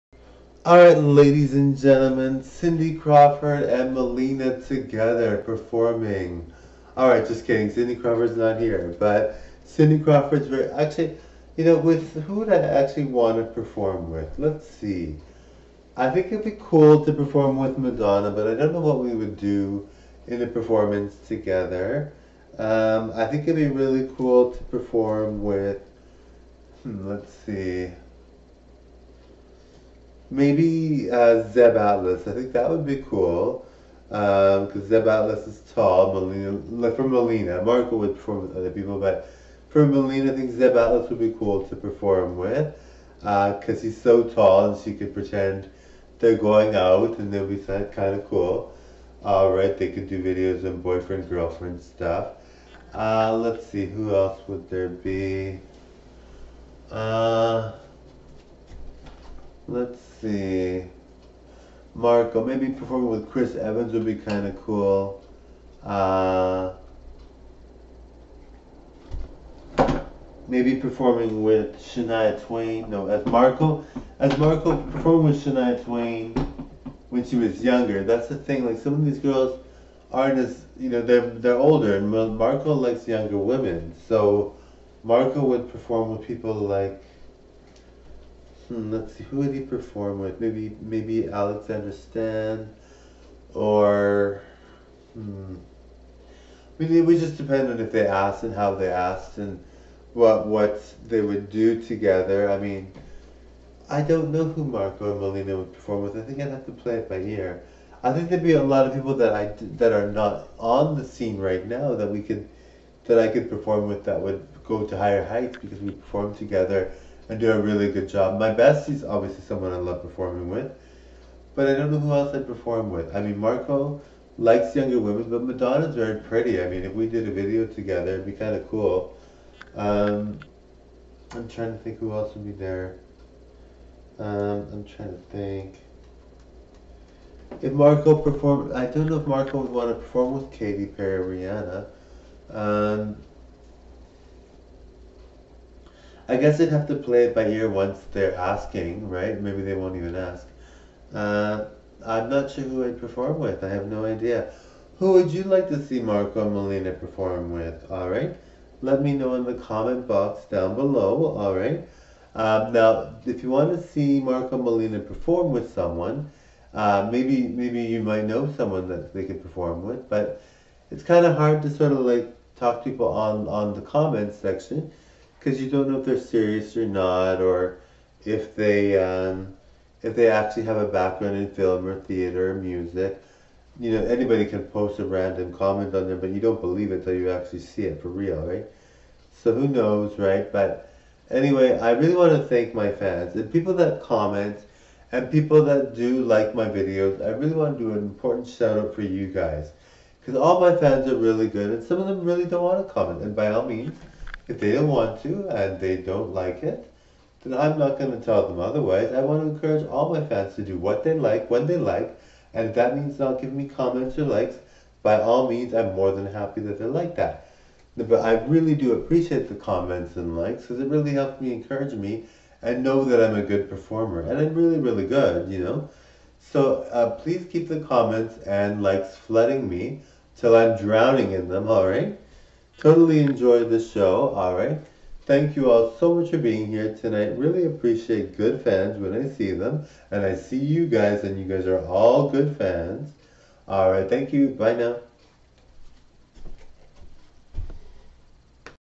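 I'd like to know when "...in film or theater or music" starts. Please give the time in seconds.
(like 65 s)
181 s.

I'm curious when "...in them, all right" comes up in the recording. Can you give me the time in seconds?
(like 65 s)
231 s.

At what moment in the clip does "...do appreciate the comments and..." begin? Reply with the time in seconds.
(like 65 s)
218 s.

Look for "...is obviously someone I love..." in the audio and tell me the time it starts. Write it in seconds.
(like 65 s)
118 s.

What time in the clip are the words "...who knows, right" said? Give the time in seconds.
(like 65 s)
189 s.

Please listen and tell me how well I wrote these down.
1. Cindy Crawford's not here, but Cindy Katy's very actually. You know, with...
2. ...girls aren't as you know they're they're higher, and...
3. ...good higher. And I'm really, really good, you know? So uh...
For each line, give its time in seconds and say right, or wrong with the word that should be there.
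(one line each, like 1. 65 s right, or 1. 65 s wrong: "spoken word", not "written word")
1. 7 s wrong: "Crawford", not "Katy"
2. 79 s wrong: "older", not "higher"
3. 223 s wrong: "performer", not "higher".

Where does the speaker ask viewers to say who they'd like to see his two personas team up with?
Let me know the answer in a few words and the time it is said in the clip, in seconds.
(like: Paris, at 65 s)
comment box, at 159 s.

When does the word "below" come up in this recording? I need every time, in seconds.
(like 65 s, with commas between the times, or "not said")
160 s.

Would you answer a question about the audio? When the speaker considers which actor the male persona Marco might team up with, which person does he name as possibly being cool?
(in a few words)
Chris Evans.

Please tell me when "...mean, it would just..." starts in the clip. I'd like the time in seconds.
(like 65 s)
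96 s.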